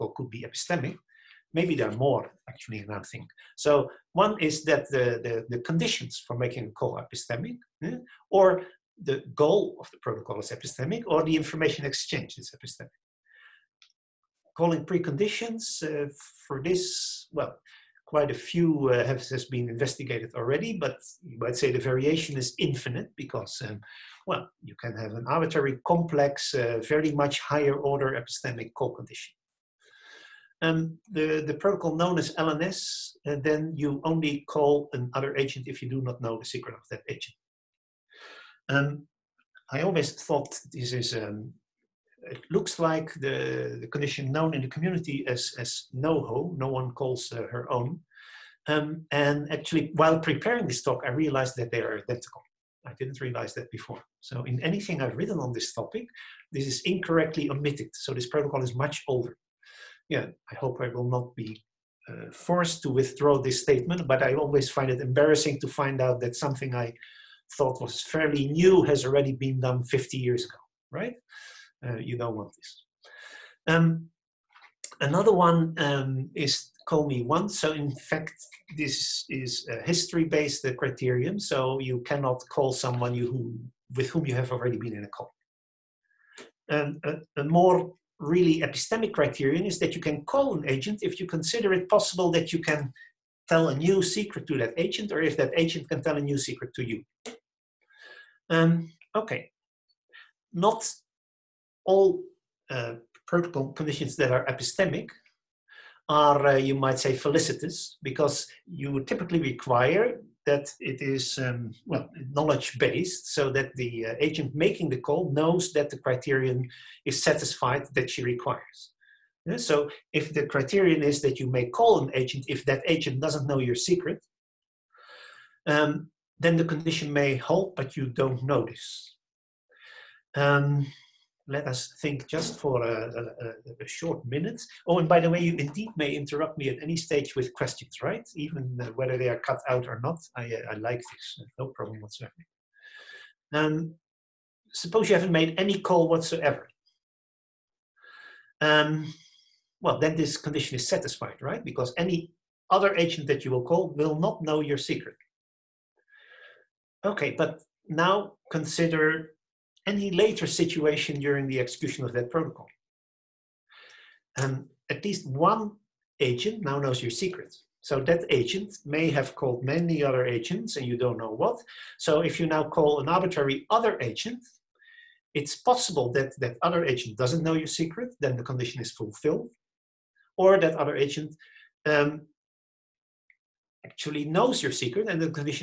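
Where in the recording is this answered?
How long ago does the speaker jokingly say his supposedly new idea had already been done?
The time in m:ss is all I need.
1:09.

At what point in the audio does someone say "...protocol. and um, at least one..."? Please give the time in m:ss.
2:42.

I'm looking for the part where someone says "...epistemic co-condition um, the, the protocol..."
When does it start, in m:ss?
0:28.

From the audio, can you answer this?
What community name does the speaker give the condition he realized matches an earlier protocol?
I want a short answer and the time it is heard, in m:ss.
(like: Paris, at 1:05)
NoHo, at 0:45.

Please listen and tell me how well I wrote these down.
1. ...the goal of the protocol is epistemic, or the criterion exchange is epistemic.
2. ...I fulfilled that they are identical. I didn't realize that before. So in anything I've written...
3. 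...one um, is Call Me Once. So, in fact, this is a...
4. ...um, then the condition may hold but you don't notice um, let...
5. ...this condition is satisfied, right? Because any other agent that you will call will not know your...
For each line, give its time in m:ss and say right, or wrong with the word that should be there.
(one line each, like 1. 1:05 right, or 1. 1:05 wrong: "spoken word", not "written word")
1. 0:09 wrong: "information", not "criterion"
2. 0:51 wrong: "realized", not "fulfilled"
3. 1:15 right
4. 2:05 right
5. 2:30 right.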